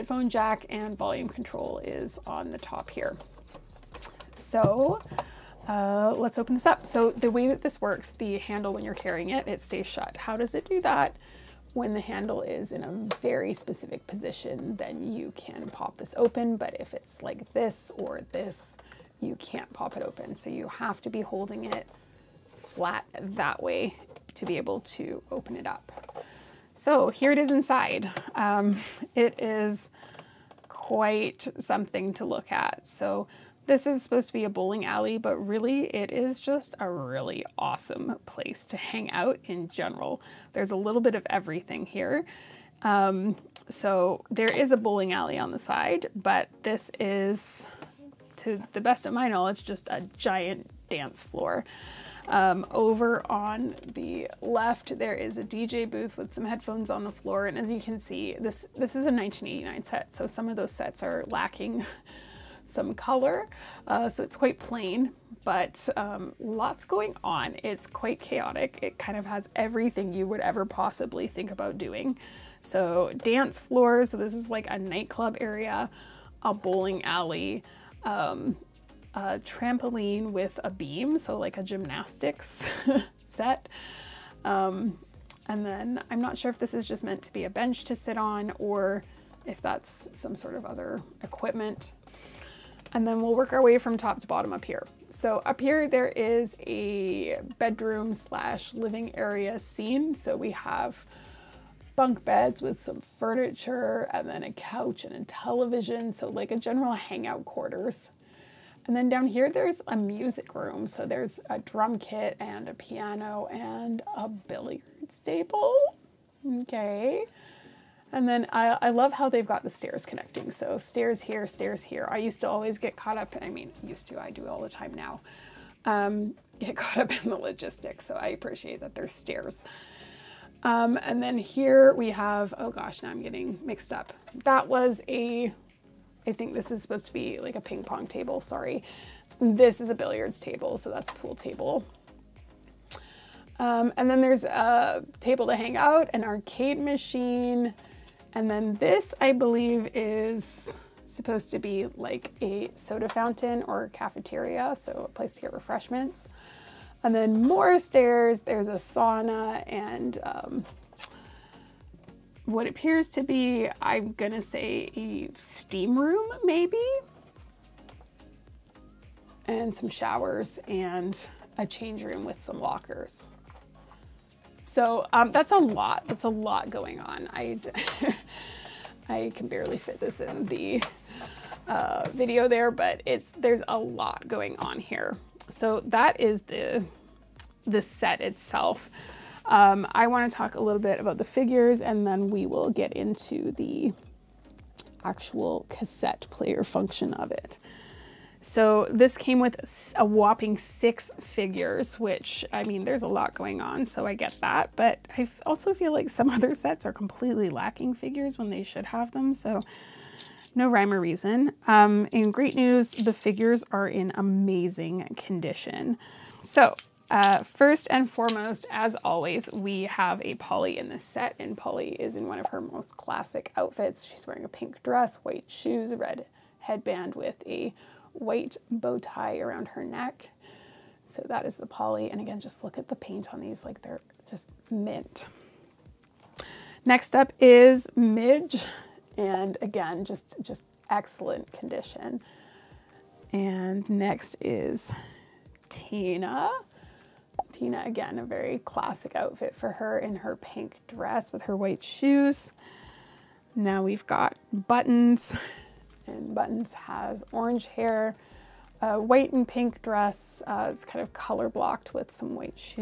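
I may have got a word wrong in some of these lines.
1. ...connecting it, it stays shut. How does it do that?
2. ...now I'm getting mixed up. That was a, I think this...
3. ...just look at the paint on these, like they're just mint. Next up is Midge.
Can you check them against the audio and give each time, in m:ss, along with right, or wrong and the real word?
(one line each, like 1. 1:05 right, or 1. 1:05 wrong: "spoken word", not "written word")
1. 0:08 wrong: "carrying", not "connecting"
2. 2:13 right
3. 3:52 right.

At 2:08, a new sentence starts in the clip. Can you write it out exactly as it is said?
So I appreciate that there's stairs.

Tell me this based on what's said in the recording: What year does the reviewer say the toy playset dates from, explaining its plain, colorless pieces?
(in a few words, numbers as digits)
1989.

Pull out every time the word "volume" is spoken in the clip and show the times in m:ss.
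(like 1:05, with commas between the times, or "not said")
0:00.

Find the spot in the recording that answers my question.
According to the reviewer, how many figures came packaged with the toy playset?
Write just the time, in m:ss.
3:20.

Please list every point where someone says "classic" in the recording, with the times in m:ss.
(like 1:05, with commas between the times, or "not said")
3:42, 4:08.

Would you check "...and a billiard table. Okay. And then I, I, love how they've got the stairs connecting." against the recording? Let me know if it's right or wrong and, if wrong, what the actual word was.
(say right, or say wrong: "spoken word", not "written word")
right.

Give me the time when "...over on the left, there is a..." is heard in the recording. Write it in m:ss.
0:52.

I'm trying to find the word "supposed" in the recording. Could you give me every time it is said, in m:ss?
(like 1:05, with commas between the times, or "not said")
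0:34, 2:16, 2:31.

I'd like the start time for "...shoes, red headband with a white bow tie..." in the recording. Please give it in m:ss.
3:45.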